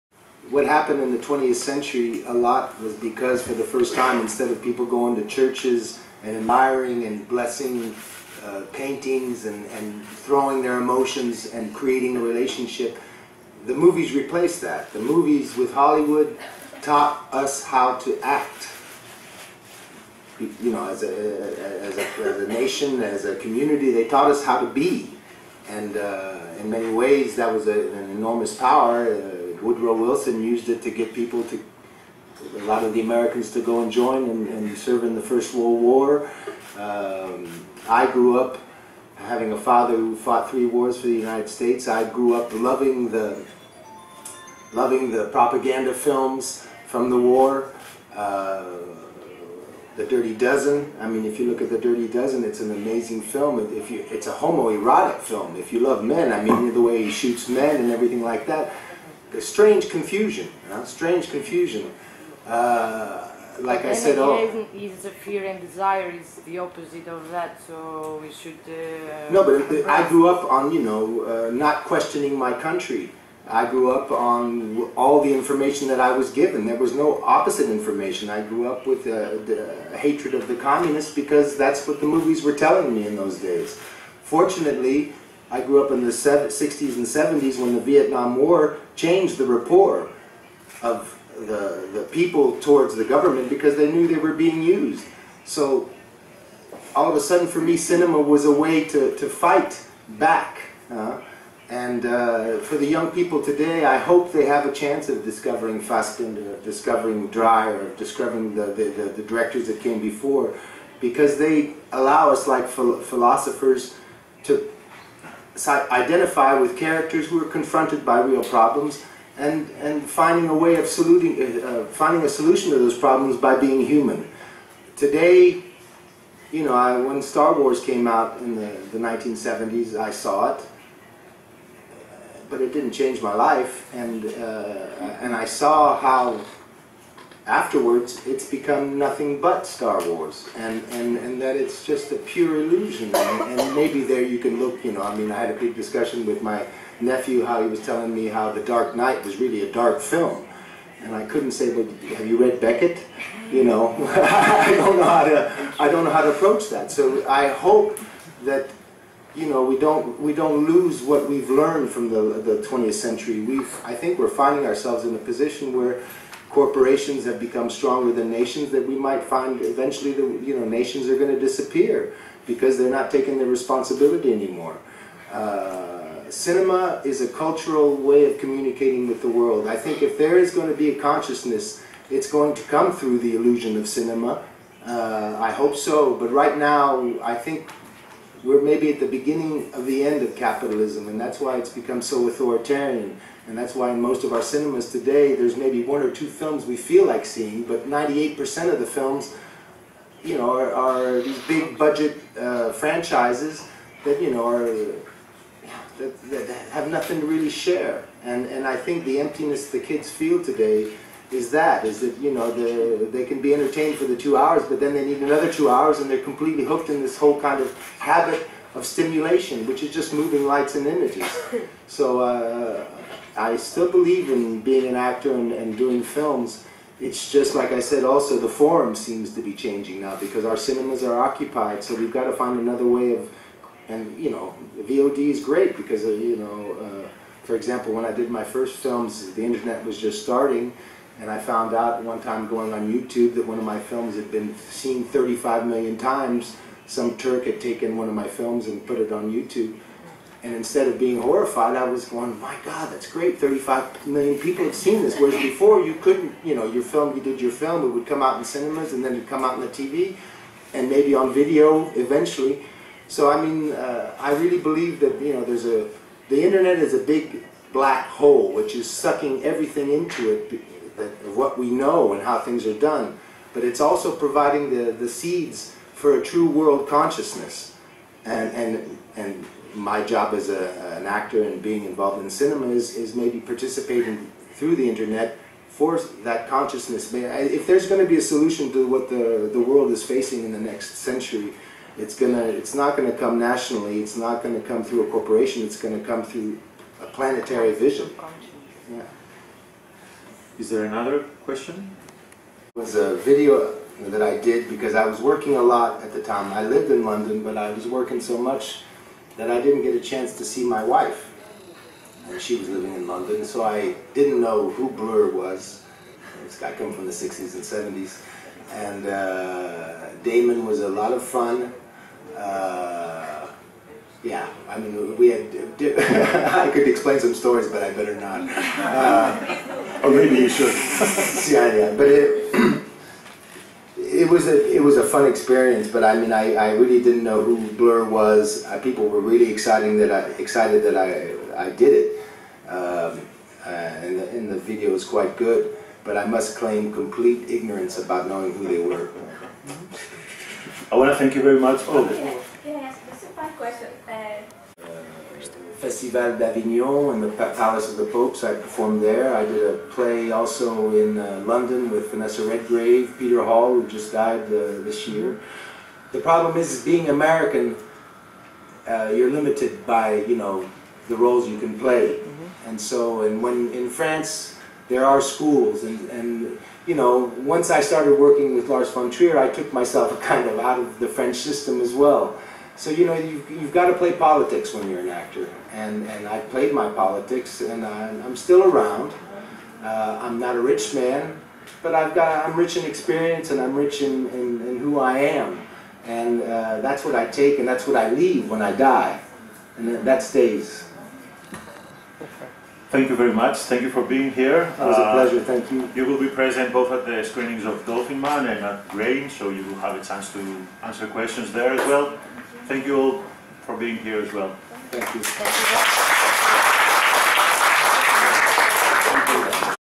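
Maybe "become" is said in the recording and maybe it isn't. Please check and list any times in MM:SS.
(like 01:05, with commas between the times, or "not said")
02:18, 02:47, 03:11.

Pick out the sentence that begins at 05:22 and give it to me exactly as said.
Uh, yeah, I mean, we had.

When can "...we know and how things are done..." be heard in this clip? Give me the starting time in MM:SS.
04:31.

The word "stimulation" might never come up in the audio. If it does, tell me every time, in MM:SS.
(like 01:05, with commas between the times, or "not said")
03:38.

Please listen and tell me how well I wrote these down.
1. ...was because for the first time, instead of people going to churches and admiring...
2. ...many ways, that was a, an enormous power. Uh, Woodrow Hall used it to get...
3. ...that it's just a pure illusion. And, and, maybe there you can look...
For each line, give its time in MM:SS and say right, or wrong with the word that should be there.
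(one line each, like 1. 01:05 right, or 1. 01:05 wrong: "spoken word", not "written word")
1. 00:02 right
2. 00:26 wrong: "Wilson", not "Hall"
3. 02:21 right.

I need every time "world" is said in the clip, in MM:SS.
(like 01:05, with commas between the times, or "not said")
00:35, 02:59, 04:36, 04:49.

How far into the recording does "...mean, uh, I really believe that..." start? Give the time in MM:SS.
04:23.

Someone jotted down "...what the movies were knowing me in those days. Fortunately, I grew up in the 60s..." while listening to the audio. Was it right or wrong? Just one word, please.
wrong.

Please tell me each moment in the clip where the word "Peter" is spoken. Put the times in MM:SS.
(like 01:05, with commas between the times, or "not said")
06:03.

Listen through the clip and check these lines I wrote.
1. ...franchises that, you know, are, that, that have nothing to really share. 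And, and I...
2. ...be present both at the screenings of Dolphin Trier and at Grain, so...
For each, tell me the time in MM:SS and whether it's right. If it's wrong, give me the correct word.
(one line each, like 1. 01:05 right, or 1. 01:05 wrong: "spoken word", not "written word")
1. 03:22 right
2. 06:46 wrong: "Man", not "Trier".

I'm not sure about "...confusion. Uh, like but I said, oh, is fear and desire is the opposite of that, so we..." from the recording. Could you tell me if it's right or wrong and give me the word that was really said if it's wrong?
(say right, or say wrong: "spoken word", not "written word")
right.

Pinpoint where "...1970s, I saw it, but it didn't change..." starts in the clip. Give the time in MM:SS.
02:08.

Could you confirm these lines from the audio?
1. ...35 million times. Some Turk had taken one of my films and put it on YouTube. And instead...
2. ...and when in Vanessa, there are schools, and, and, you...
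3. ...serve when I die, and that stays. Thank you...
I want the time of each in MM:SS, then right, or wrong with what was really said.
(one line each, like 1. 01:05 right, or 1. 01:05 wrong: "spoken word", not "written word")
1. 04:05 right
2. 06:13 wrong: "France", not "Vanessa"
3. 06:38 wrong: "leave", not "serve".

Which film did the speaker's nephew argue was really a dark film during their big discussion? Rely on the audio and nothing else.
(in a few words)
The Dark Knight.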